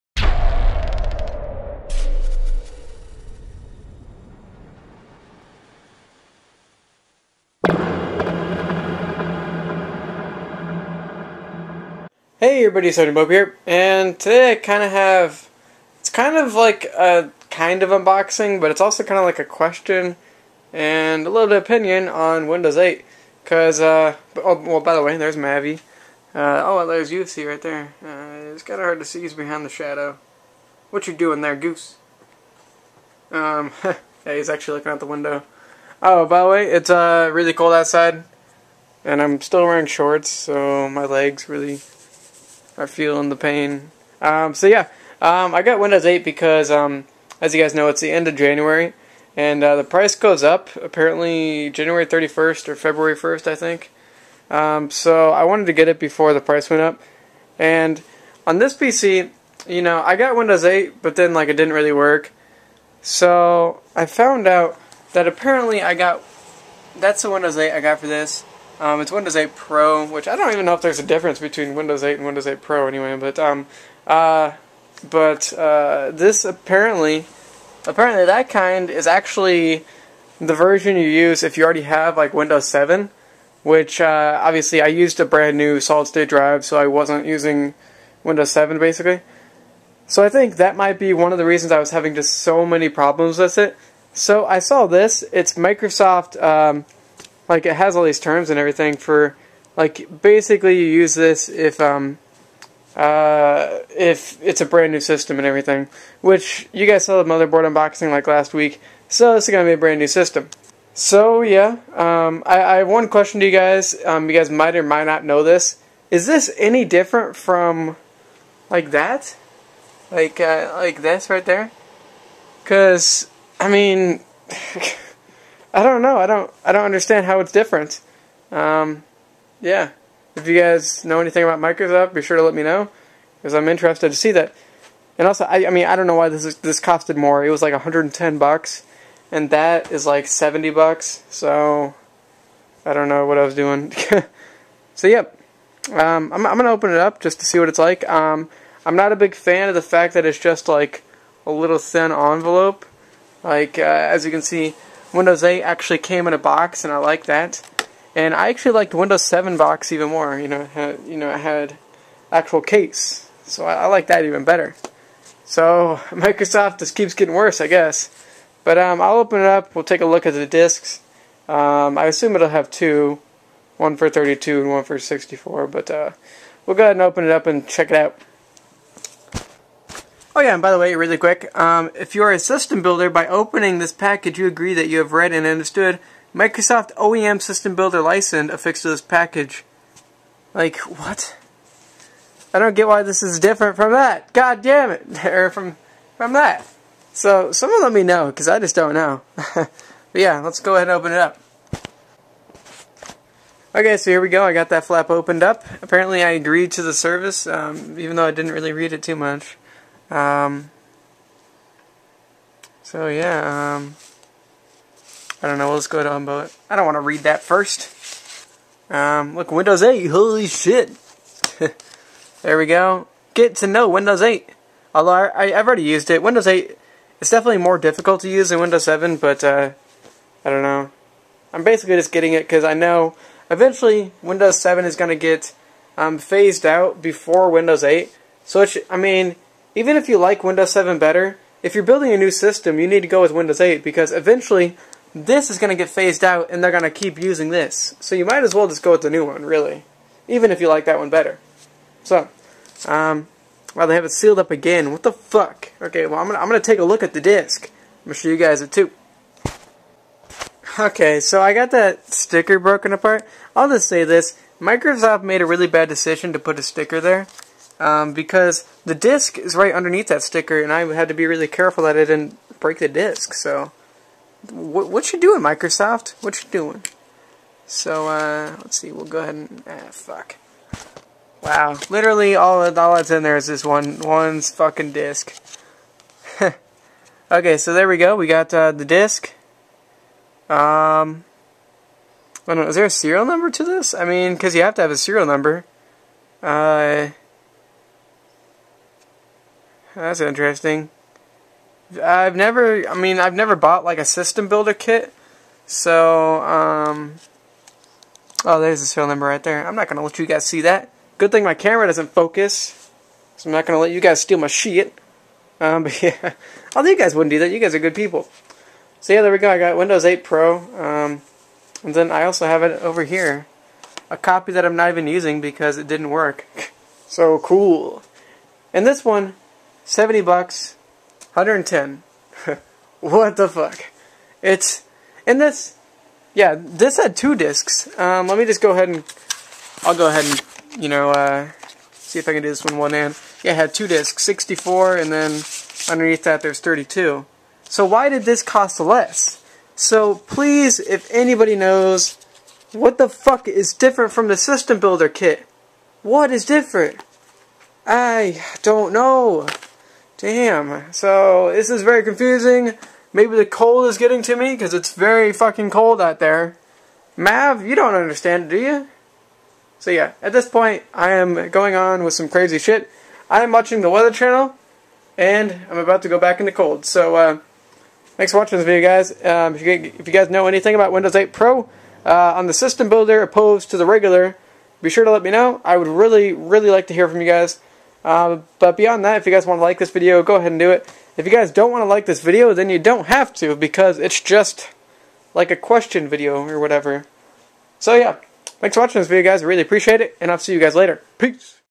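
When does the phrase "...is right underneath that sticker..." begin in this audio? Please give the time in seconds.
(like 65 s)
269 s.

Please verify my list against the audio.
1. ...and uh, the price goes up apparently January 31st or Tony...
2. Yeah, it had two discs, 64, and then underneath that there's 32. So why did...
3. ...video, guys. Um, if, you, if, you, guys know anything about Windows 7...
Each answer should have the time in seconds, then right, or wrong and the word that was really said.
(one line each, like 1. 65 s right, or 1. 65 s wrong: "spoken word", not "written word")
1. 49 s wrong: "February", not "Tony"
2. 343 s right
3. 378 s wrong: "8", not "7".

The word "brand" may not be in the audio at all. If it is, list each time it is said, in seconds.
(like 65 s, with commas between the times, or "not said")
85 s, 104 s, 109 s.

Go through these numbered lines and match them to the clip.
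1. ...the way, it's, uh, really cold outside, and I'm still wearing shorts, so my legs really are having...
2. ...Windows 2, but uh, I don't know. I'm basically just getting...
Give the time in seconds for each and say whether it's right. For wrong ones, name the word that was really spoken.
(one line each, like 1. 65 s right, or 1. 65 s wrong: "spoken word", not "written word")
1. 36 s wrong: "feeling", not "having"
2. 228 s wrong: "7", not "2".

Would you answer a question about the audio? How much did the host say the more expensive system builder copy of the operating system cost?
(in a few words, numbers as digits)
110 bucks.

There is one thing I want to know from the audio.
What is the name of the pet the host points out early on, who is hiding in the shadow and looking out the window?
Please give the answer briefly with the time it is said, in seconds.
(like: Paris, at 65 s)
Mavi, at 25 s.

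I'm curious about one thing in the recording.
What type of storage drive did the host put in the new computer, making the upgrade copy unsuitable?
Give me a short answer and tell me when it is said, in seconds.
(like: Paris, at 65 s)
solid state drive, at 85 s.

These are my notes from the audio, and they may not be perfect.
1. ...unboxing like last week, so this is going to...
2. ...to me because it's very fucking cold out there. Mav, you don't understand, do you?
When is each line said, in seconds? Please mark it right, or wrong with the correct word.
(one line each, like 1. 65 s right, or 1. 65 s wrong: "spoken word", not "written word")
1. 107 s right
2. 364 s right.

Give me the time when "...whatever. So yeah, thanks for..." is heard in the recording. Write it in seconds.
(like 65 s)
396 s.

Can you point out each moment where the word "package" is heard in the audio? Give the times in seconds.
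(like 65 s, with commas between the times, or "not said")
183 s, 189 s.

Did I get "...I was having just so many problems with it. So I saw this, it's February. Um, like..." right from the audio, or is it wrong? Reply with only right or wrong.
wrong.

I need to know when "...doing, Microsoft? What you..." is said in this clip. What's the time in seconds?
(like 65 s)
275 s.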